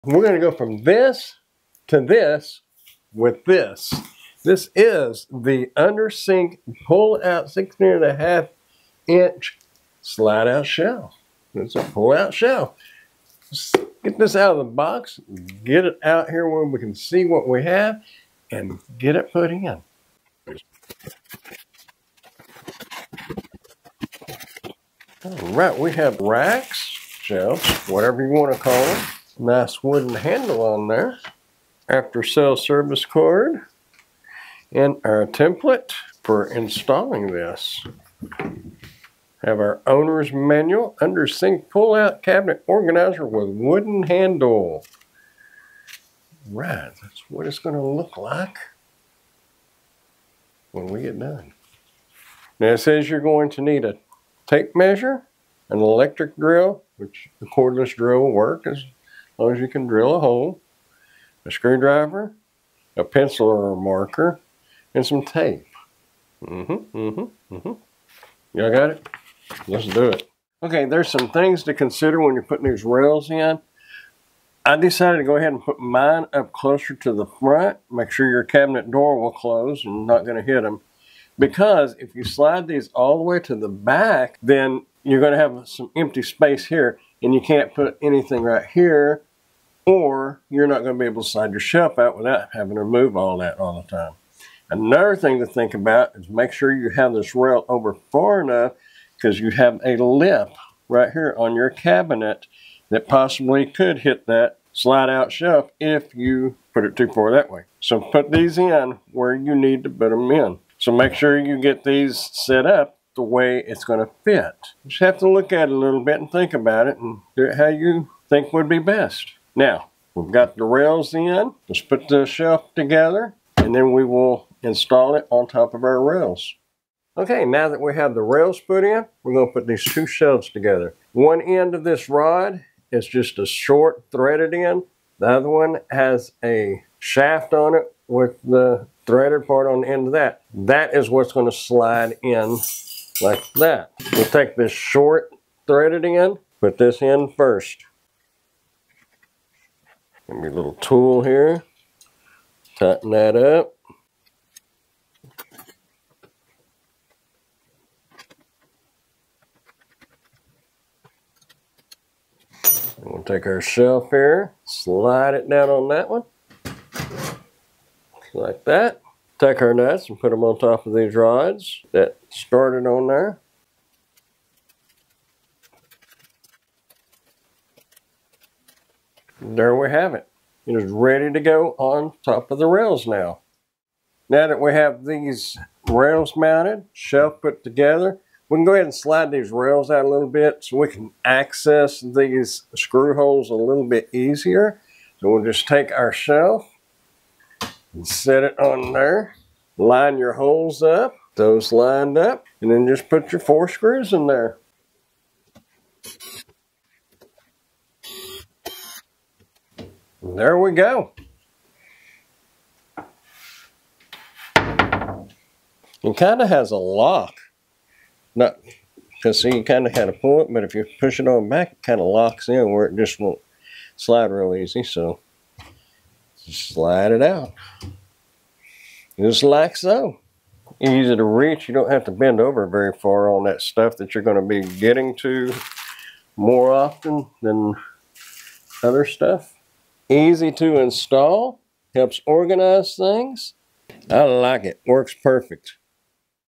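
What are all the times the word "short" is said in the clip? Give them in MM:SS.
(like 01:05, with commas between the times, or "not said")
02:13, 02:24.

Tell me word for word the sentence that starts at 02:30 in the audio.
Give me a little tool here.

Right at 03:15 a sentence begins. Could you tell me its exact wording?
So we'll just take our shelf and set it on there.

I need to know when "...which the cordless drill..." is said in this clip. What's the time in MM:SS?
00:56.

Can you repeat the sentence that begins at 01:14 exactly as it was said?
I decided to go ahead and put mine up closer to the front.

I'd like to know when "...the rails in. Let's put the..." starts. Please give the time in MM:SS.
02:00.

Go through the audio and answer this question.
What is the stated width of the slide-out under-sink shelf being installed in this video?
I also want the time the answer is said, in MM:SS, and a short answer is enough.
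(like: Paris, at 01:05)
16 and a half inch, at 00:07.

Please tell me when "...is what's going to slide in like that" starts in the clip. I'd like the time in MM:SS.
02:20.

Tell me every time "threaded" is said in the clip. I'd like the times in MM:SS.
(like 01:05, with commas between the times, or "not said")
02:14, 02:19, 02:25.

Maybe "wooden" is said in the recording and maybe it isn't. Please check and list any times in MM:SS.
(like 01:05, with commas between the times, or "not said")
00:29, 00:43.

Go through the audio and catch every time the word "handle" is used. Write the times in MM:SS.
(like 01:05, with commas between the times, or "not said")
00:30, 00:44.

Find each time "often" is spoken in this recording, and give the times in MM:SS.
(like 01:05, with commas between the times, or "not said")
03:56.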